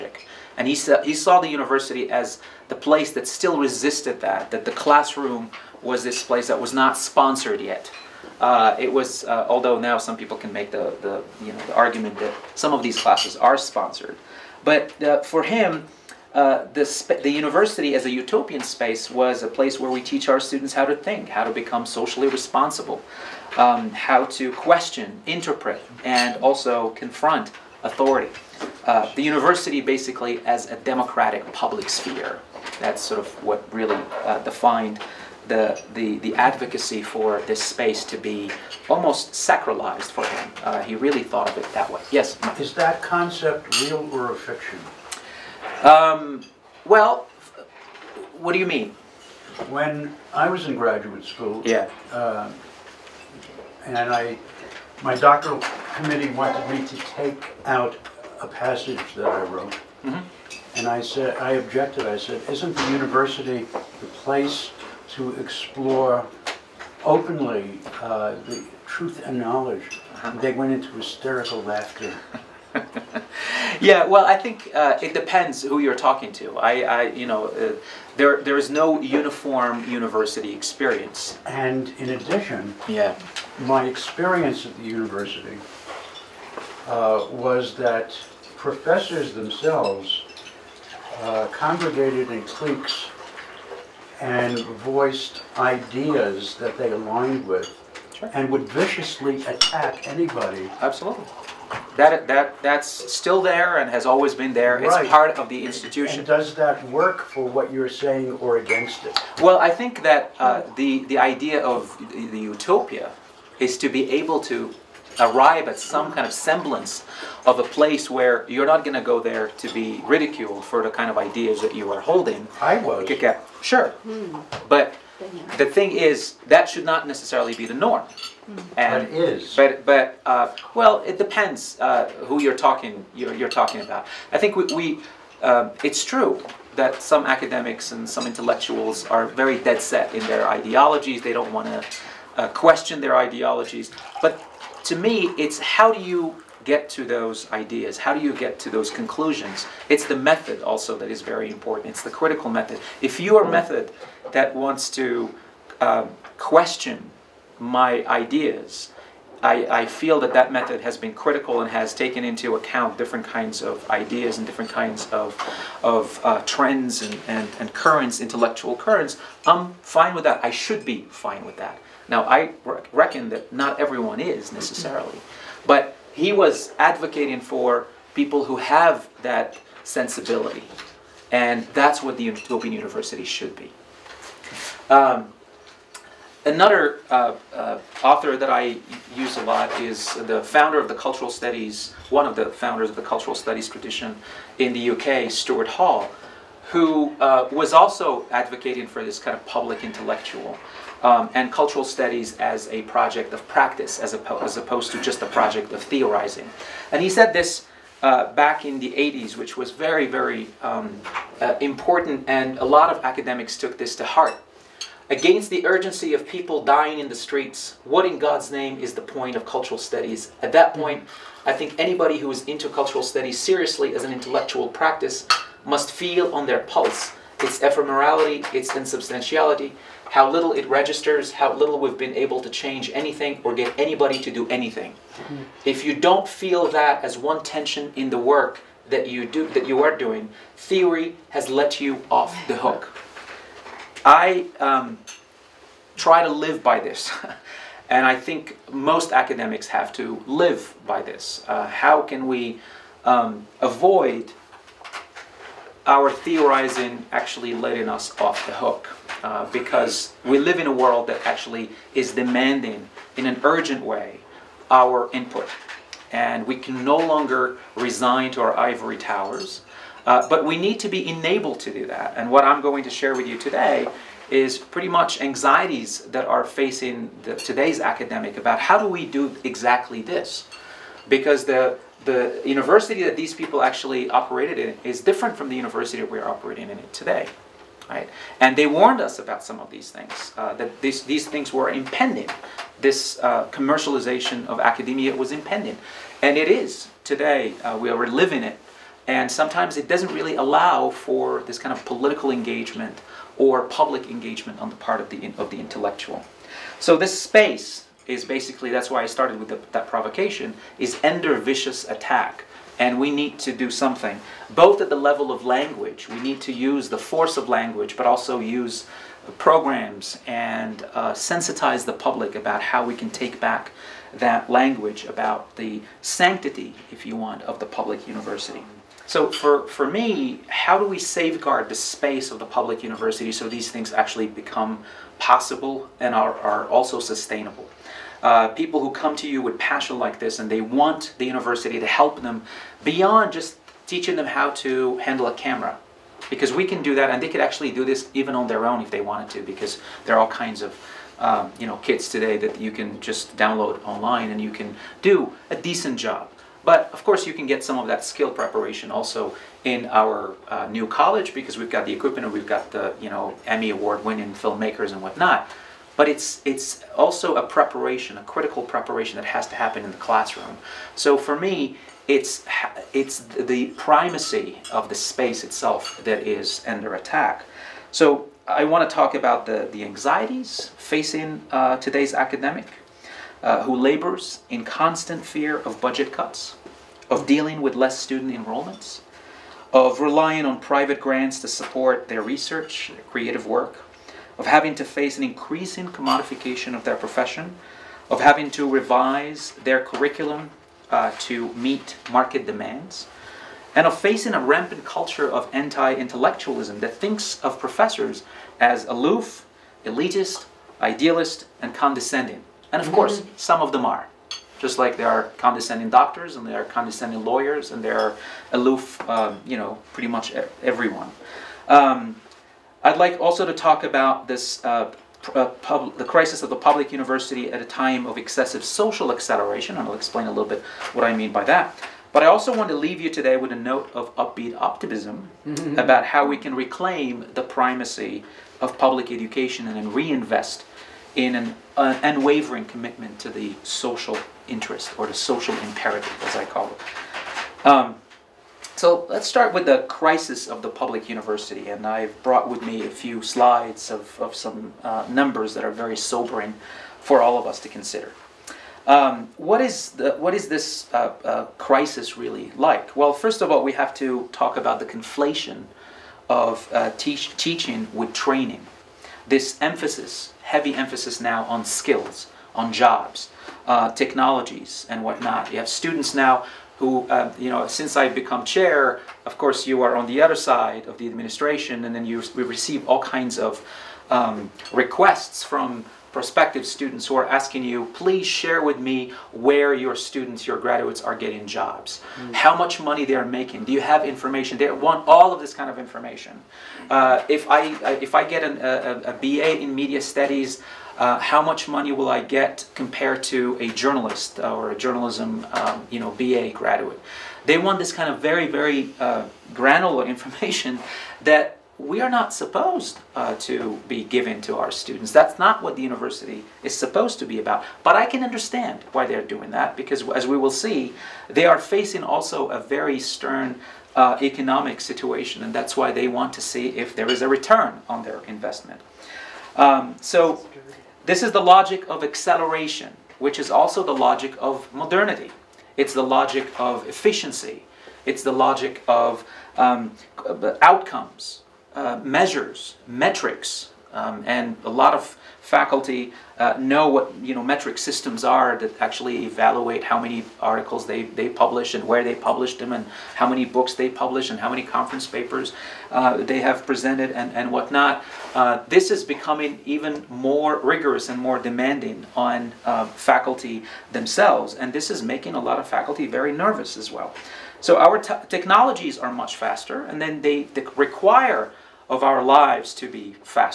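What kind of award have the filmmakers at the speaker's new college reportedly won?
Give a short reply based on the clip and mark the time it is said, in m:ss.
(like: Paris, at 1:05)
Emmy, at 6:03.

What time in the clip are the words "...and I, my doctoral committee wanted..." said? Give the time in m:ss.
0:53.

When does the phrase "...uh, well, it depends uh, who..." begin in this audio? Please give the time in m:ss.
2:10.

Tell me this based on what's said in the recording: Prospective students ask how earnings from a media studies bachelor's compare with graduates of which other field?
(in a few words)
Journalism.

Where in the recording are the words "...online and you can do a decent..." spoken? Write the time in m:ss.
5:53.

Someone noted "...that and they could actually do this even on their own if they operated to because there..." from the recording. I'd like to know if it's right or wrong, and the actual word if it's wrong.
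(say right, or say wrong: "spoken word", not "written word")
wrong: "wanted", not "operated".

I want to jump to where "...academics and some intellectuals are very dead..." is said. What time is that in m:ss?
2:17.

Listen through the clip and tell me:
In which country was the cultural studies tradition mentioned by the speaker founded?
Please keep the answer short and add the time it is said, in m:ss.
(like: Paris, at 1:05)
UK, at 3:14.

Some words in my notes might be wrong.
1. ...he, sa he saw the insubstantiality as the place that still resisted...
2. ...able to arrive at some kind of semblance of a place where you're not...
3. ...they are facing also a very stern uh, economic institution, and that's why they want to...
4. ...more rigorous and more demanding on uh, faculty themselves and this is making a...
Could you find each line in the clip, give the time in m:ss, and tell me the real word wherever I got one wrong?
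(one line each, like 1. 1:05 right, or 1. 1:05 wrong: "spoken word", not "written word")
1. 0:00 wrong: "university", not "insubstantiality"
2. 1:54 right
3. 8:41 wrong: "situation", not "institution"
4. 9:20 right.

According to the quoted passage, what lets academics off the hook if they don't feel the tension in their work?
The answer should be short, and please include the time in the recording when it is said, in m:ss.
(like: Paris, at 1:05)
Theory, at 4:00.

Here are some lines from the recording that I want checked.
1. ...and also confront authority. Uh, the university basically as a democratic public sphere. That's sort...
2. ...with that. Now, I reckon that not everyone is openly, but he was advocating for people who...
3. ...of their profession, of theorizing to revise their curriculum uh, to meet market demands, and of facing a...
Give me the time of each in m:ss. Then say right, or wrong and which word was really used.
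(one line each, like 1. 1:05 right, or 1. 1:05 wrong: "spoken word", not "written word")
1. 0:26 right
2. 2:51 wrong: "necessarily", not "openly"
3. 6:36 wrong: "having", not "theorizing".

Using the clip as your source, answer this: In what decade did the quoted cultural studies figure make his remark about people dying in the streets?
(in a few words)
The 80s.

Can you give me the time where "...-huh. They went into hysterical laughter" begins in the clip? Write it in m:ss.
1:10.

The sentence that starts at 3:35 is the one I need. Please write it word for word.
Against the urgency of people dying in the streets, what in God's name is the point of cultural studies?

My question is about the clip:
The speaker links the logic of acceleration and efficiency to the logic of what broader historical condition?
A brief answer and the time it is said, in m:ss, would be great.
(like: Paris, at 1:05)
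Modernity, at 8:54.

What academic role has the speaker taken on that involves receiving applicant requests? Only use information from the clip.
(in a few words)
Chair.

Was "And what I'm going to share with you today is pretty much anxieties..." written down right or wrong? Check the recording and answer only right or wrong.
right.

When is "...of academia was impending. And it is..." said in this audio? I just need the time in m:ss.
4:54.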